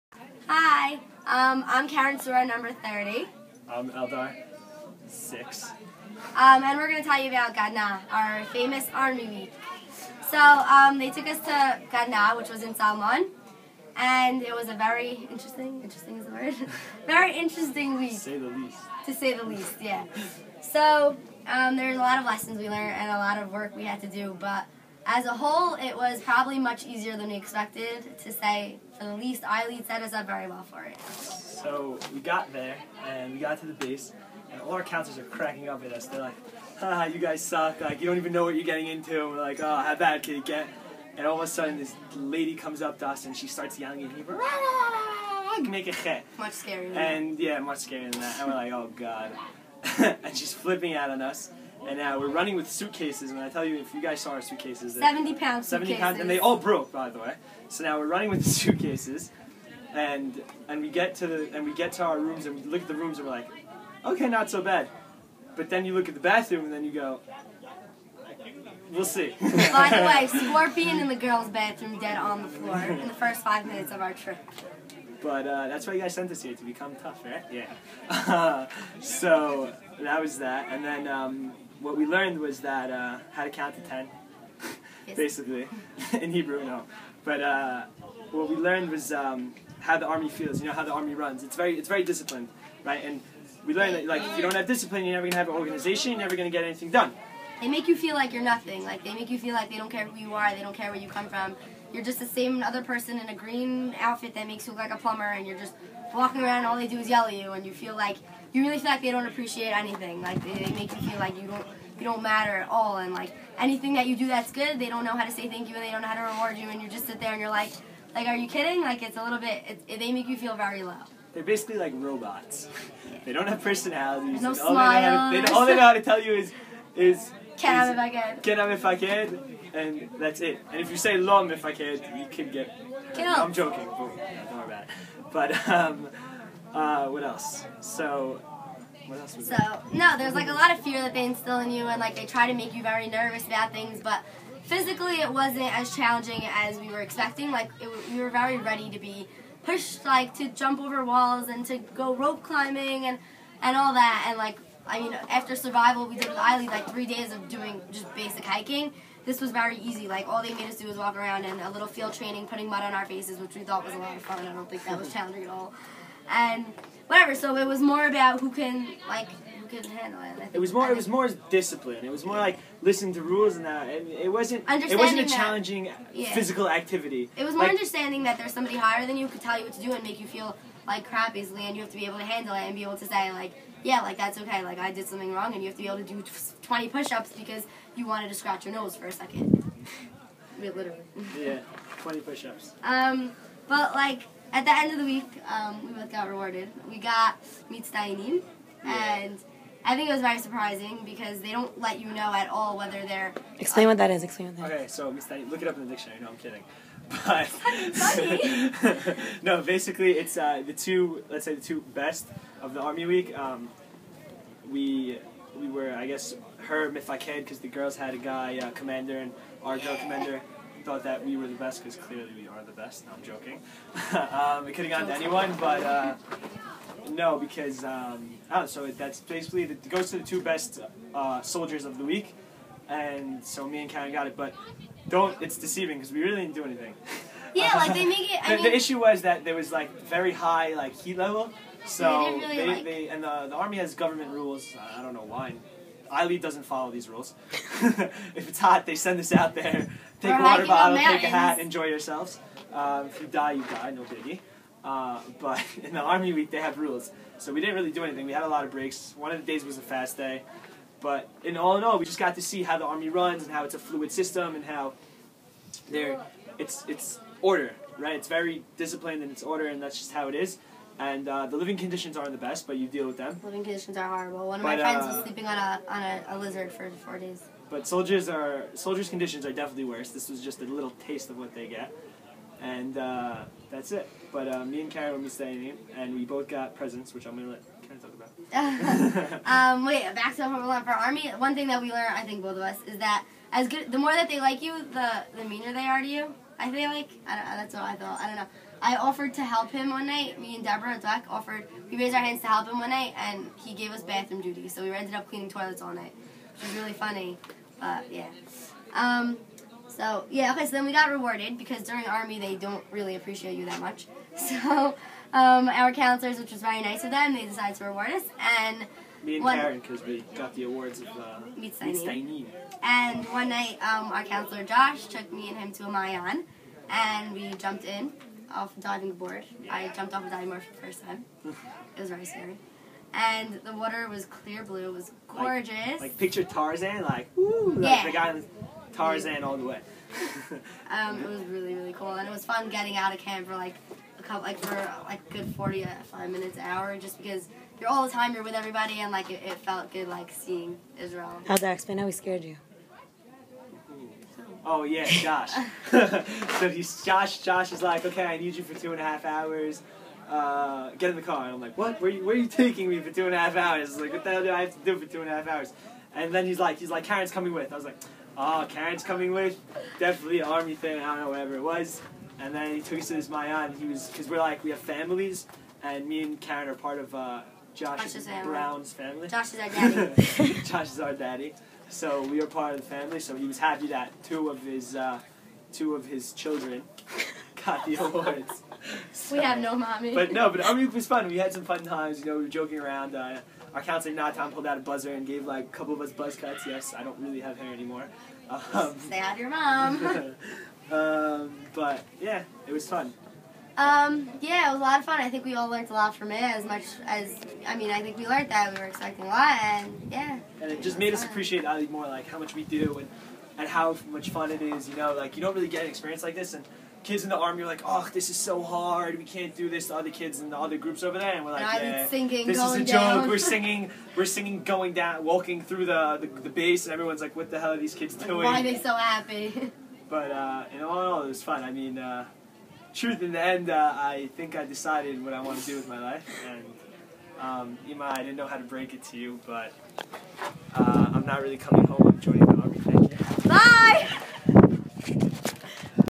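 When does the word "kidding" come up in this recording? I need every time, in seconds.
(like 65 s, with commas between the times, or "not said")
118 s, 206 s.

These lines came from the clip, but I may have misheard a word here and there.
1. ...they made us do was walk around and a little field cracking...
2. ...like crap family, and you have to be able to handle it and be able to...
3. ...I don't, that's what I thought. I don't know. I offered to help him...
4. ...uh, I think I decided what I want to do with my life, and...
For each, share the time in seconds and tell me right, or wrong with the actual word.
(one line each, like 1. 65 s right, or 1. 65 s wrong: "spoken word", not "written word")
1. 160 s wrong: "training", not "cracking"
2. 180 s wrong: "easily", not "family"
3. 297 s right
4. 433 s right.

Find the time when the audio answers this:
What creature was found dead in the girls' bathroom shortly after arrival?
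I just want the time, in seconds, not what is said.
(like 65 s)
70 s.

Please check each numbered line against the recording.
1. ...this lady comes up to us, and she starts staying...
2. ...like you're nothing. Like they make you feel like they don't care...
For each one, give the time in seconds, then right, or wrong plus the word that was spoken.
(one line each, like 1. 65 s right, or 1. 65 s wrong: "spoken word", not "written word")
1. 41 s wrong: "yelling", not "staying"
2. 98 s right.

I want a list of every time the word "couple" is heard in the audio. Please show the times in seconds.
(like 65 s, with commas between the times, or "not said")
344 s, 395 s.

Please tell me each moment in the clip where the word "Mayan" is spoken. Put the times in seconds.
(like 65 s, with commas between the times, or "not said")
325 s, 373 s.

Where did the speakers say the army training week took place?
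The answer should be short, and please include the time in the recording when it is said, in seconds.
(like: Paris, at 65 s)
Salmon, at 12 s.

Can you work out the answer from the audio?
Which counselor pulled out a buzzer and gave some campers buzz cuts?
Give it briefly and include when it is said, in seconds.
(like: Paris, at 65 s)
Natan, at 394 s.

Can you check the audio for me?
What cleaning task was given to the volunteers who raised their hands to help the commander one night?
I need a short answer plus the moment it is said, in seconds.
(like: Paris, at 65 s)
Bathroom duty, at 304 s.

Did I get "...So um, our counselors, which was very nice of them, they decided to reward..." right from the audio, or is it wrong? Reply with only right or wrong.
right.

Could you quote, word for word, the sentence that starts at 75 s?
But uh, that's why you guys sent us here to become tough, right?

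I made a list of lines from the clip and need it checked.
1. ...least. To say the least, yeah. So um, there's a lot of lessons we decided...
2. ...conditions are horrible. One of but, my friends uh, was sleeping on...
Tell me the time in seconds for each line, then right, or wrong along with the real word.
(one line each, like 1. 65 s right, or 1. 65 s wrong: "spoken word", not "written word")
1. 18 s wrong: "learned", not "decided"
2. 273 s right.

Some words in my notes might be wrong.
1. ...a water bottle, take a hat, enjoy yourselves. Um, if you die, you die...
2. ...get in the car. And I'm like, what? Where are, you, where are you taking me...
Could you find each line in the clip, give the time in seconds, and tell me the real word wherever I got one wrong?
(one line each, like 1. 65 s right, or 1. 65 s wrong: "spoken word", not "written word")
1. 250 s right
2. 360 s right.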